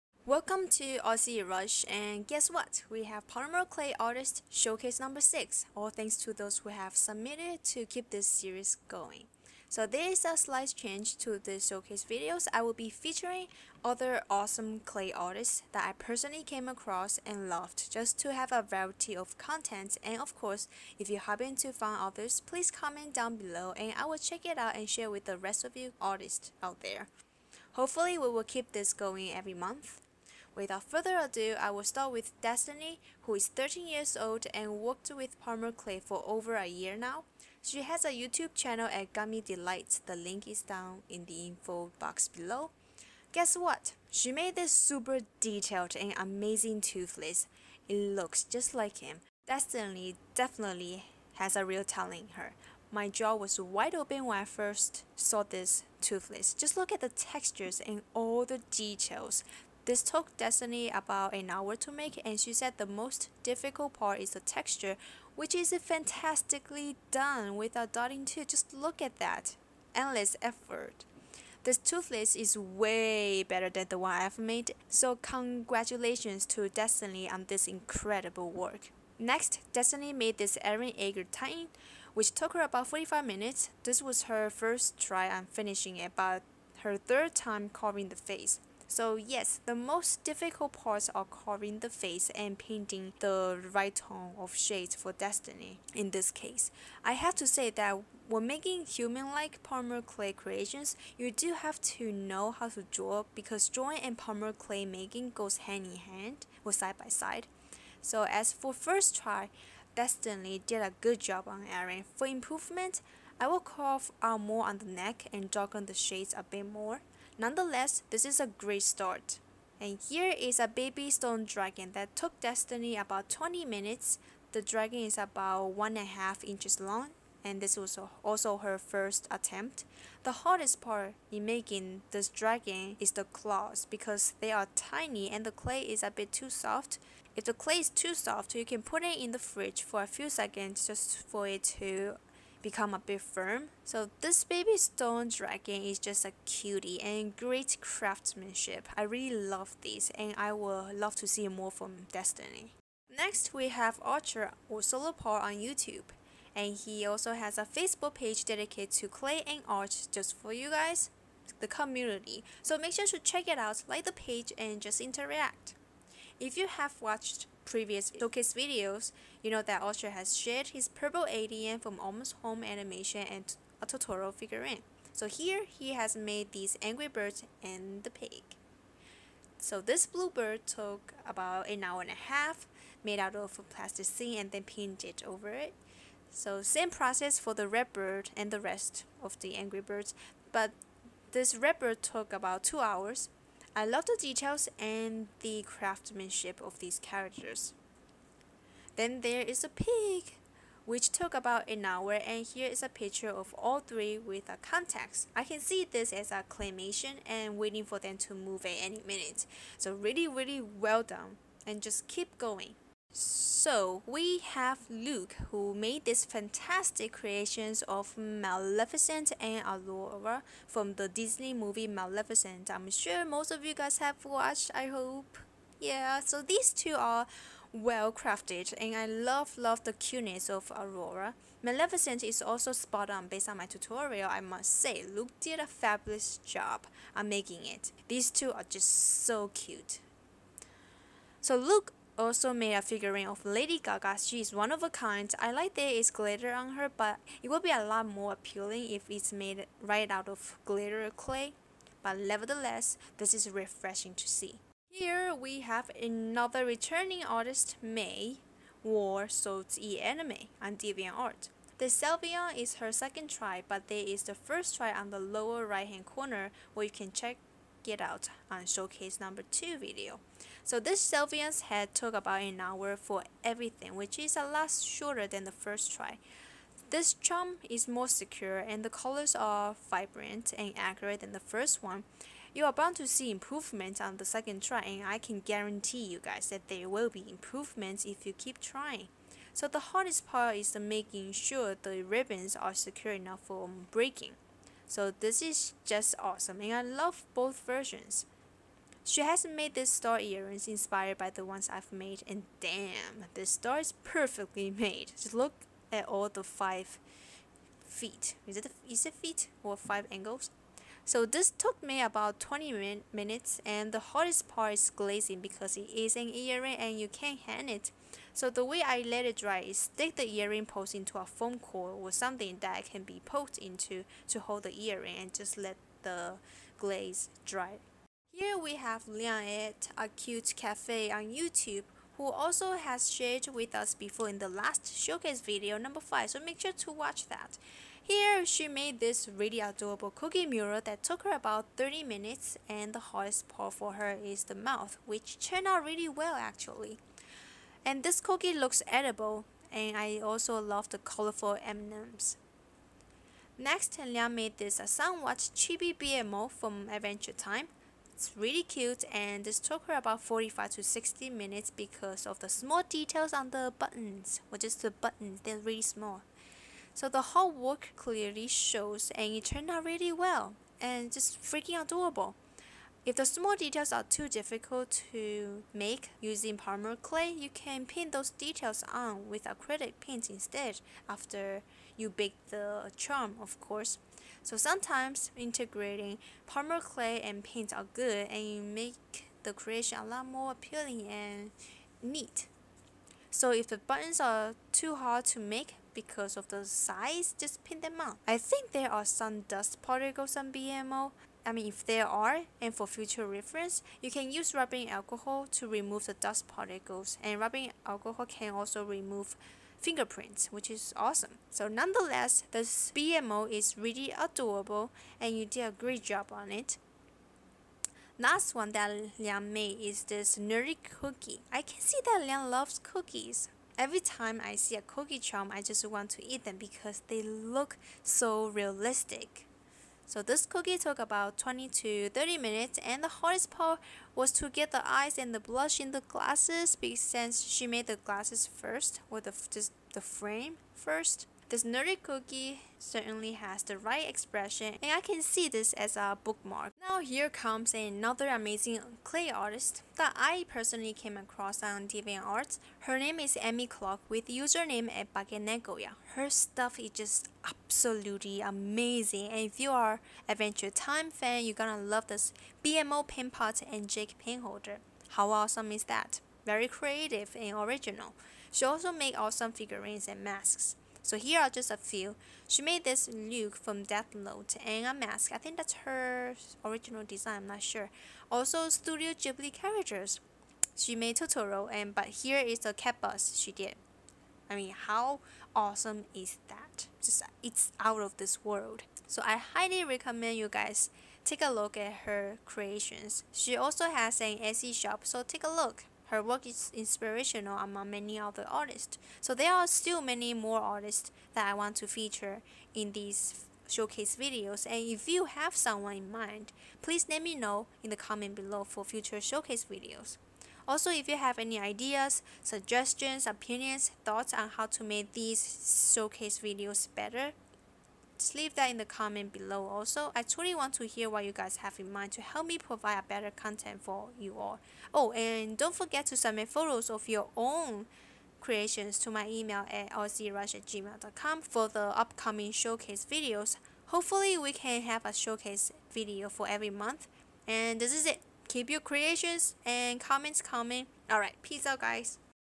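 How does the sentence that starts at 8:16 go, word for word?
Her work is inspirational among many other artists.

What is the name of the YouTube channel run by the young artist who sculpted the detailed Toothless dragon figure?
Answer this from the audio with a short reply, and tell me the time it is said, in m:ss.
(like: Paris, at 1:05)
Gummy Delights, at 0:39.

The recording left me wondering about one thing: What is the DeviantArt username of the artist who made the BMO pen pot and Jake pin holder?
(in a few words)
Bakenekoya.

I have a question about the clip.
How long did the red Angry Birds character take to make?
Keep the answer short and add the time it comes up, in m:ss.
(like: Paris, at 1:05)
two hours, at 3:12.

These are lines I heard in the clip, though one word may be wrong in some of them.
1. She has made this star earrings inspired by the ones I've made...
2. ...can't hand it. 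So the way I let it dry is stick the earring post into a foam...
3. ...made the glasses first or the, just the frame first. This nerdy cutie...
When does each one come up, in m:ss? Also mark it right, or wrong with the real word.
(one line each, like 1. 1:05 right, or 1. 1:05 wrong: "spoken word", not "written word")
1. 4:59 right
2. 5:17 right
3. 7:17 wrong: "cookie", not "cutie".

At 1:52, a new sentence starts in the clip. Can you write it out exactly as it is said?
For improvement, I will carve out more on the neck and darken the shades a bit more.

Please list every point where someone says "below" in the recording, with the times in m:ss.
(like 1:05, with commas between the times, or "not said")
0:23, 0:42, 8:28, 8:39.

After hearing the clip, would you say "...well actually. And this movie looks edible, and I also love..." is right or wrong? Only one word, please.
wrong.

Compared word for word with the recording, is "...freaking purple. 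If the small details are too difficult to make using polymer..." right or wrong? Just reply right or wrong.
wrong.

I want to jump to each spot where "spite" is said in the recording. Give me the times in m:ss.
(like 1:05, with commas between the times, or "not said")
not said.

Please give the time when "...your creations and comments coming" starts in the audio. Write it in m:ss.
8:58.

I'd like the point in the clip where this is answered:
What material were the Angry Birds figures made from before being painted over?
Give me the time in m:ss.
3:03.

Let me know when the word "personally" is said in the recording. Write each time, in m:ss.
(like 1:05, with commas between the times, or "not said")
0:16, 7:30.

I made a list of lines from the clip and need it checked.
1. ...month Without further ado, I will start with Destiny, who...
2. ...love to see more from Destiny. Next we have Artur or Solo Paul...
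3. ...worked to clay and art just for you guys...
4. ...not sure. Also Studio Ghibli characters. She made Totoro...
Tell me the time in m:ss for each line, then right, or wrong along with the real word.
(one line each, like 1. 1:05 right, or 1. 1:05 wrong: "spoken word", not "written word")
1. 0:29 right
2. 2:30 right
3. 2:38 wrong: "dedicated", not "worked"
4. 7:57 right.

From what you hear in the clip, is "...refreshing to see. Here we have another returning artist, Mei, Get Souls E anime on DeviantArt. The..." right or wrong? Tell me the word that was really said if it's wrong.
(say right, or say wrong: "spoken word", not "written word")
wrong: "War", not "Get".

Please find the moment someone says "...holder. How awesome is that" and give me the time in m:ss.
7:44.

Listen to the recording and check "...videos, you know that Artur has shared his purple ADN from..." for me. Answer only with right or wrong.
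right.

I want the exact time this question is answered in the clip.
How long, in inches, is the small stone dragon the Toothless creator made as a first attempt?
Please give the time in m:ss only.
2:05.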